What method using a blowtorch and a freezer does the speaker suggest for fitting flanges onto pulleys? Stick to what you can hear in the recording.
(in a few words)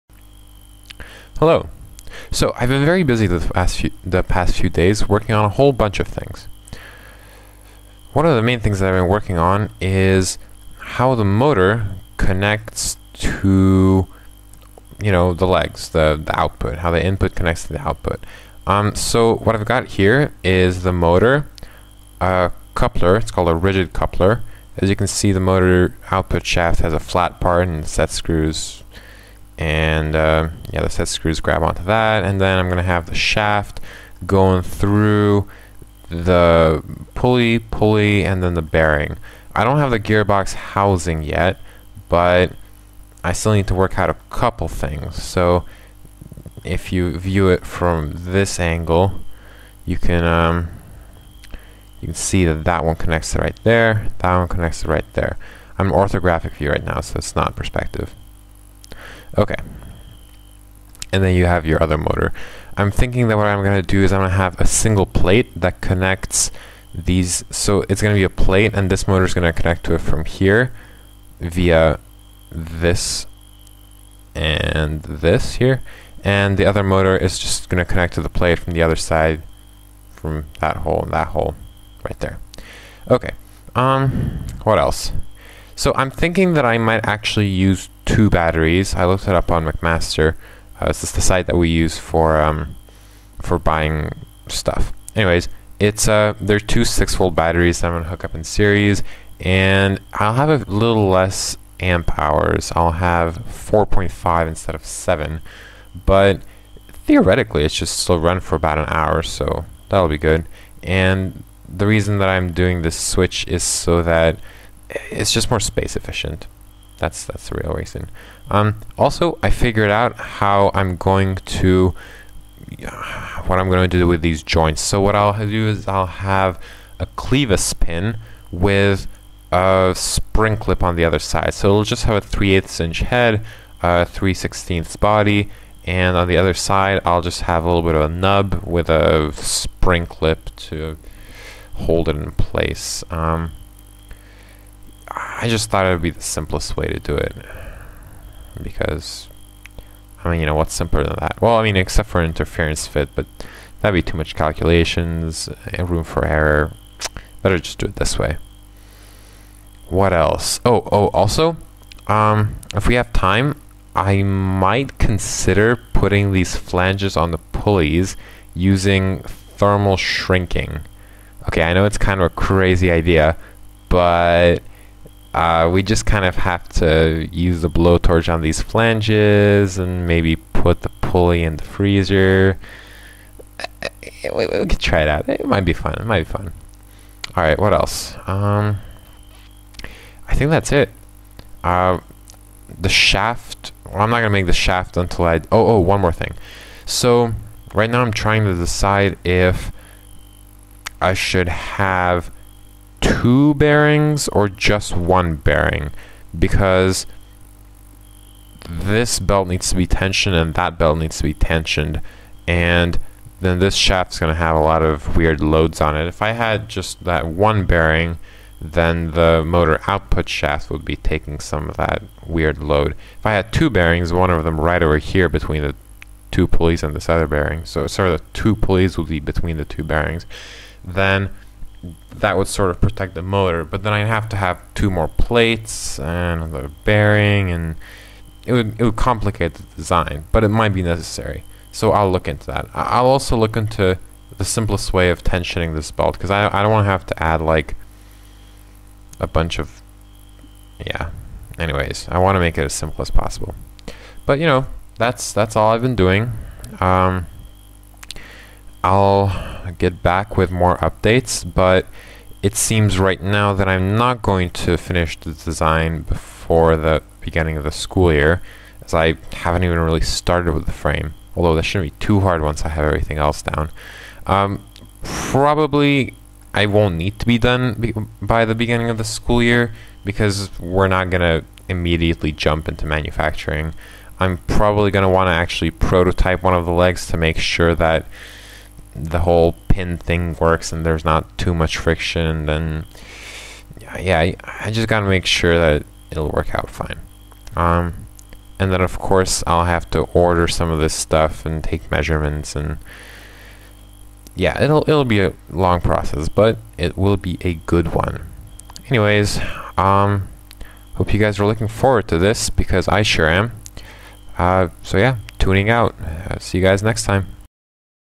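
thermal shrinking.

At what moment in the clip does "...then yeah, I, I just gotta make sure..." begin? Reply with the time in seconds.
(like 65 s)
292 s.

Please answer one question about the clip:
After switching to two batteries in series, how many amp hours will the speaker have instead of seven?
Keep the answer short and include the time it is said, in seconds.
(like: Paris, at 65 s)
4.5, at 103 s.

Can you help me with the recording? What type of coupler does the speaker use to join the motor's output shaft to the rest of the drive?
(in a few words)
rigid coupler.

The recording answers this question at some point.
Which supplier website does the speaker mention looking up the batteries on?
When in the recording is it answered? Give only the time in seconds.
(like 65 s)
89 s.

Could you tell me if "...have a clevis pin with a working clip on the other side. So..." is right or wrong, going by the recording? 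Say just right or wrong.
wrong.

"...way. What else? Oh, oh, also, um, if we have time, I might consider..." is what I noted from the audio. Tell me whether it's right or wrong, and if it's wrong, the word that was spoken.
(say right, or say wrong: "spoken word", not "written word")
right.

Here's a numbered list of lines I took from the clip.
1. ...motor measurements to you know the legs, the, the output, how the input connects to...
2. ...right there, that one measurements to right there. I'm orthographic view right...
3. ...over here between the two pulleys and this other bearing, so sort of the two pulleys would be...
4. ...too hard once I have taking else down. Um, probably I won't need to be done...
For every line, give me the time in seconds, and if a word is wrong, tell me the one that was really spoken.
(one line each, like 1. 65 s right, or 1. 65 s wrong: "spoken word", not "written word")
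1. 11 s wrong: "connects", not "measurements"
2. 53 s wrong: "connects", not "measurements"
3. 224 s right
4. 272 s wrong: "everything", not "taking".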